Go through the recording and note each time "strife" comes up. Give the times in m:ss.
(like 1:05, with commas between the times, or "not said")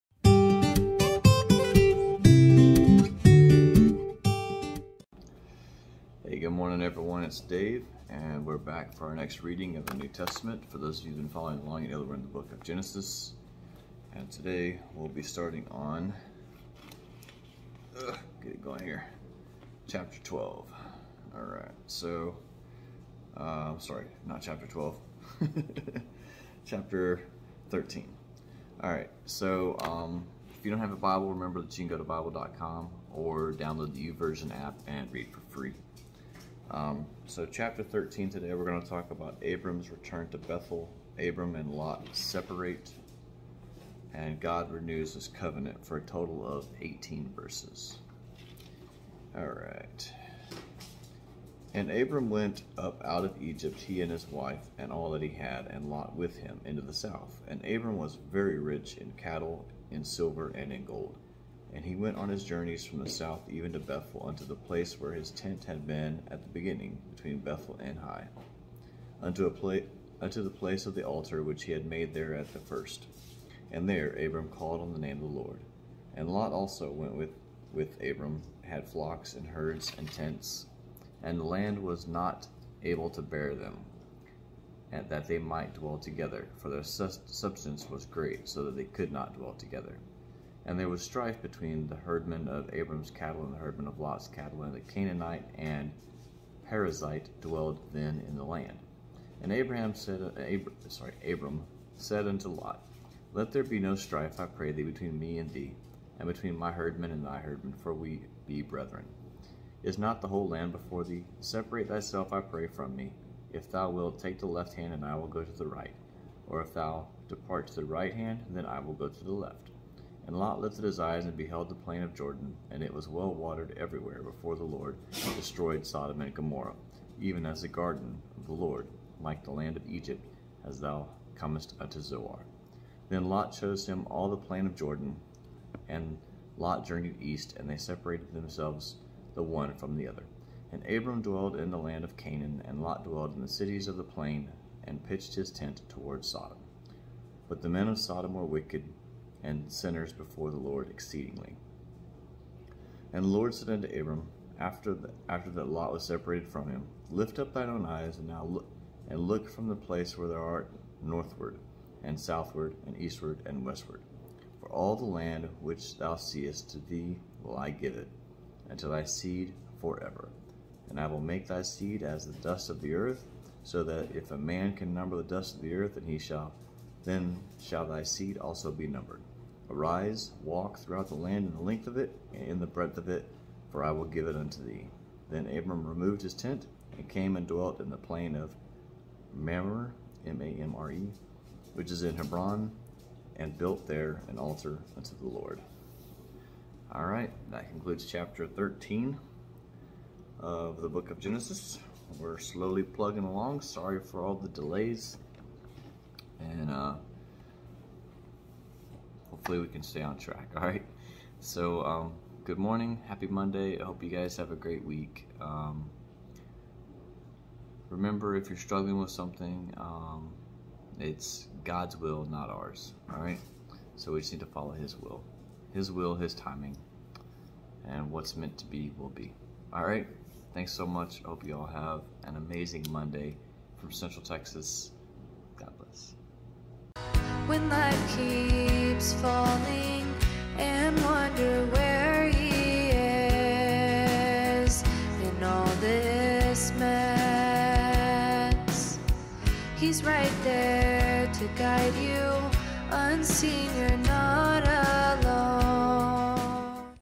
1:31, 1:43.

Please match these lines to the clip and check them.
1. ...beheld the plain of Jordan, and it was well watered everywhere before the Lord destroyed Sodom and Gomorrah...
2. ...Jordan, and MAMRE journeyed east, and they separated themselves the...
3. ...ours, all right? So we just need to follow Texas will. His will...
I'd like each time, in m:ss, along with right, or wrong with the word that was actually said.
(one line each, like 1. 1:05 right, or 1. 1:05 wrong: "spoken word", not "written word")
1. 2:01 right
2. 2:14 wrong: "Lot", not "MAMRE"
3. 3:42 wrong: "His", not "Texas".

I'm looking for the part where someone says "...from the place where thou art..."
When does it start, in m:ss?
2:39.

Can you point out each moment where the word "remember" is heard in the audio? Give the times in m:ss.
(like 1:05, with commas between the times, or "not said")
0:31, 3:37.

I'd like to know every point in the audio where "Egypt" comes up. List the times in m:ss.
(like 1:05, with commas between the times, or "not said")
0:53, 2:09.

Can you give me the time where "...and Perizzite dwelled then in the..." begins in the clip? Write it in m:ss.
1:35.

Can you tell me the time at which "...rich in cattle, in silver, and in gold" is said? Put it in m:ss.
0:58.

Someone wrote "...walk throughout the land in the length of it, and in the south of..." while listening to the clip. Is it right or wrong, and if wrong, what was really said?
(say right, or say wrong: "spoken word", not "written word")
wrong: "breadth", not "south".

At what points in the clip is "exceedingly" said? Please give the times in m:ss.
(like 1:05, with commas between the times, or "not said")
2:30.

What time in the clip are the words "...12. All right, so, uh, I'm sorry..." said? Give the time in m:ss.
0:20.